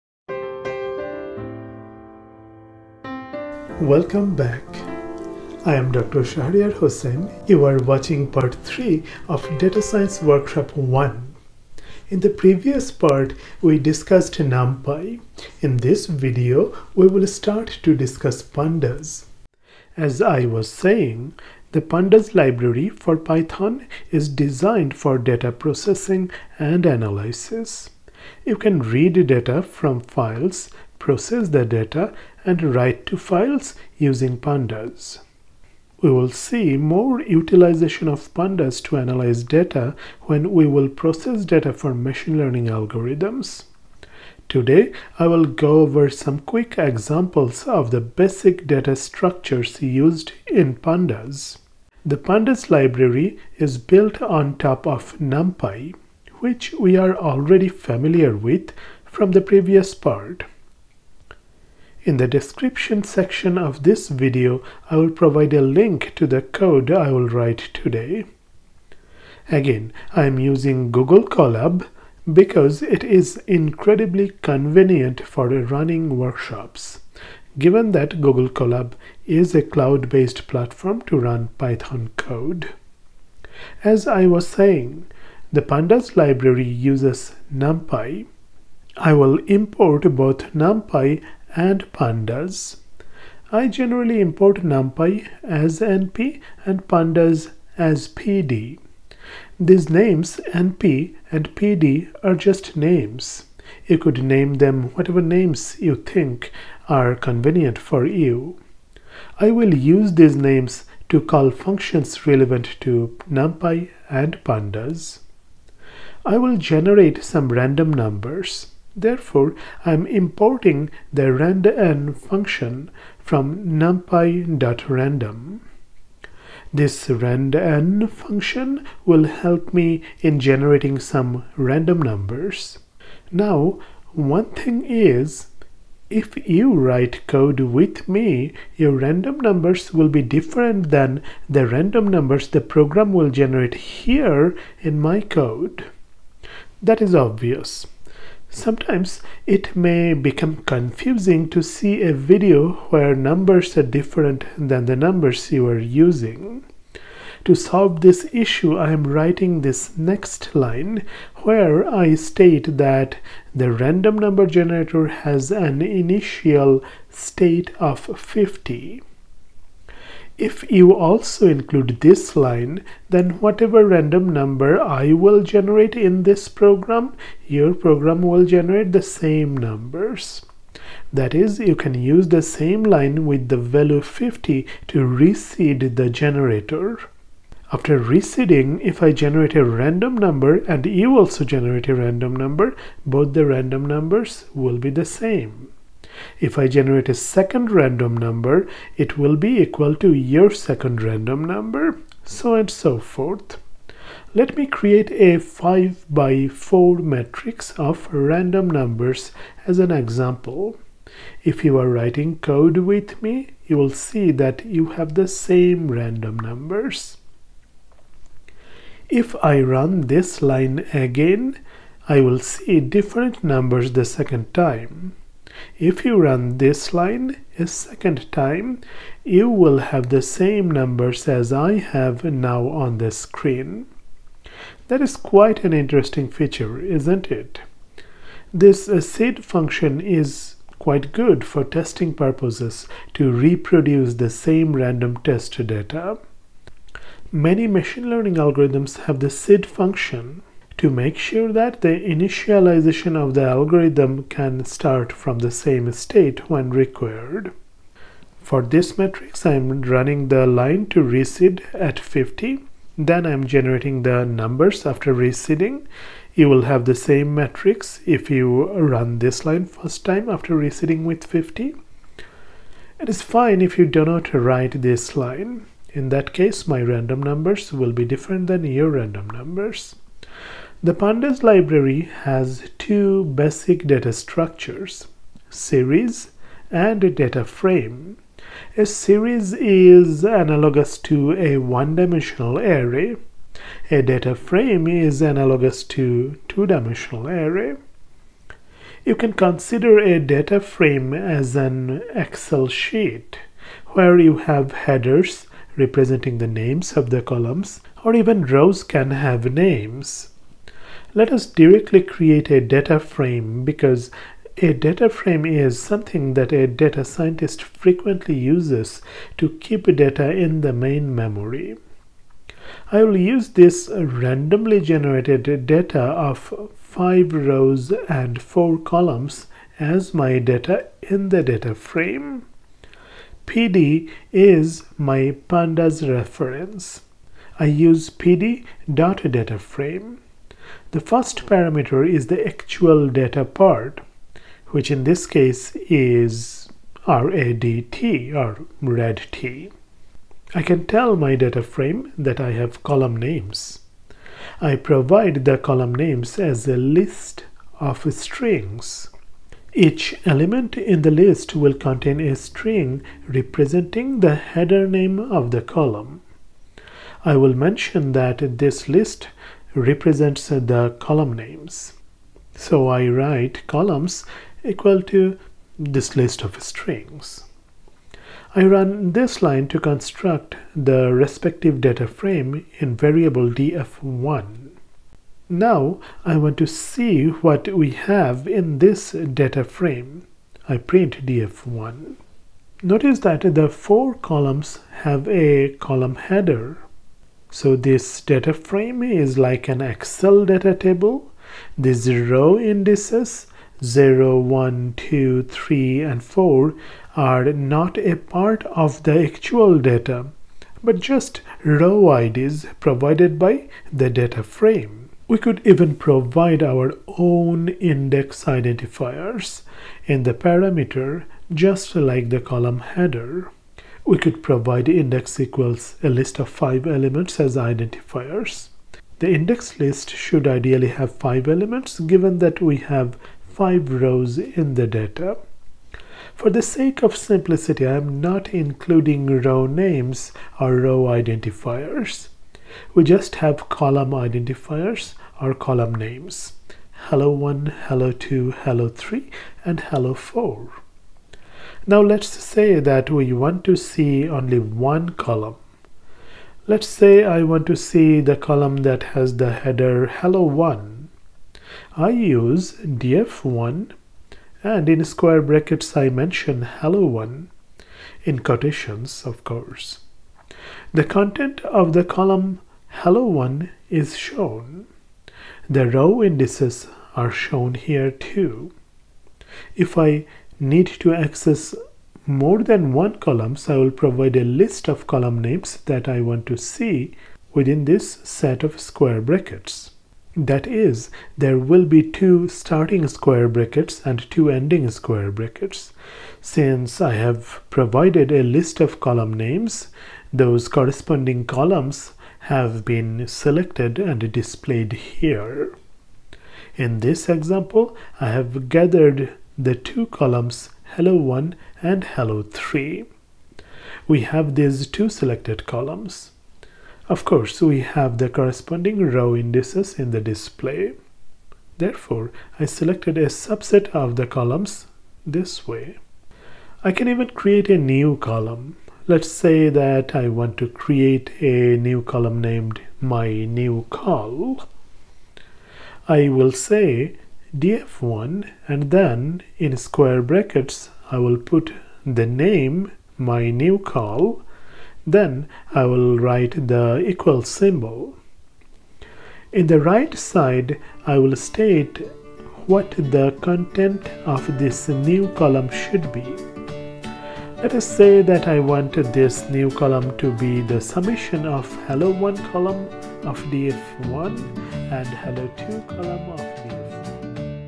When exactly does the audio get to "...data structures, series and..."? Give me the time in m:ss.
4:43.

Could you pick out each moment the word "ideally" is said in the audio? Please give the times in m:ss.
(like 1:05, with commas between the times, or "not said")
7:10.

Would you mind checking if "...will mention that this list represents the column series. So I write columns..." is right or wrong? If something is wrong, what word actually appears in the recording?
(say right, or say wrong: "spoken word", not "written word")
wrong: "names", not "series".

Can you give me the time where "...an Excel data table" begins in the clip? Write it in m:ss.
6:39.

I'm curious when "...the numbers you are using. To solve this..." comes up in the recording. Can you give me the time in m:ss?
2:34.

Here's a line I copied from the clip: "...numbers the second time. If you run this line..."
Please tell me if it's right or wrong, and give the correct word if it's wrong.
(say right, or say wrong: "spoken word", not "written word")
right.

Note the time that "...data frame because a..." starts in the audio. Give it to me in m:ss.
5:12.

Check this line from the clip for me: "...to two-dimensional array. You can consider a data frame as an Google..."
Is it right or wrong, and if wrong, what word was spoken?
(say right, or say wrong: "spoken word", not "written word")
wrong: "Excel", not "Google".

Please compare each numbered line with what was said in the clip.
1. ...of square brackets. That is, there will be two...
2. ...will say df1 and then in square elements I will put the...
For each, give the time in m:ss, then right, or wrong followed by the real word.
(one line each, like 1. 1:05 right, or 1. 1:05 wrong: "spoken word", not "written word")
1. 8:08 right
2. 8:56 wrong: "brackets", not "elements".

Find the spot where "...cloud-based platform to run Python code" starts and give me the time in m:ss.
1:19.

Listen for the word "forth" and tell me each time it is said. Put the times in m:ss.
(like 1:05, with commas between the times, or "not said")
3:22.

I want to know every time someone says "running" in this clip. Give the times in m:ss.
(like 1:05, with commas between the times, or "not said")
1:15, 4:19.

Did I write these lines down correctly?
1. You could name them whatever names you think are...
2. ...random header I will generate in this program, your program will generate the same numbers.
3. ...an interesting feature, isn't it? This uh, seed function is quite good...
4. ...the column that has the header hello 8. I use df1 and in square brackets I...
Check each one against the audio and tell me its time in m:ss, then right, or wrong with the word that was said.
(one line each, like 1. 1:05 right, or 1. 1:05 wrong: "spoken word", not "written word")
1. 1:43 right
2. 2:53 wrong: "number", not "header"
3. 3:55 right
4. 7:38 wrong: "1", not "8".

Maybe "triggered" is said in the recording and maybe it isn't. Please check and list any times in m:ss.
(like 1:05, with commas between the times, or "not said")
not said.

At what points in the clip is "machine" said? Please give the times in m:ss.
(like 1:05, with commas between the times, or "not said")
0:41, 4:07.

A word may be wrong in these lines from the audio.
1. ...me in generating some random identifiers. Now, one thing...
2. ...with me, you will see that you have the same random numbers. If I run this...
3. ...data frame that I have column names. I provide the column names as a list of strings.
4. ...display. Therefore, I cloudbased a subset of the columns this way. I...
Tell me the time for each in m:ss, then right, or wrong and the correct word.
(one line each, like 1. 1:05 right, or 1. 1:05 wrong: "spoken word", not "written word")
1. 2:09 wrong: "numbers", not "identifiers"
2. 3:32 right
3. 5:51 right
4. 8:40 wrong: "selected", not "cloudbased".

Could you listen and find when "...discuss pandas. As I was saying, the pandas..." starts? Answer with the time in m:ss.
0:17.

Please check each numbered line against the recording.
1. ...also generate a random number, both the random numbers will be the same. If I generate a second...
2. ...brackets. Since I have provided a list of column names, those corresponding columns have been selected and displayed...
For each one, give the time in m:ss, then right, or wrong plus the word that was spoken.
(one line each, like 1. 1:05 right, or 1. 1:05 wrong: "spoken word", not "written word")
1. 3:11 right
2. 8:15 right.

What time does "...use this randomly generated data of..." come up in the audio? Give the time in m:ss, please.
5:23.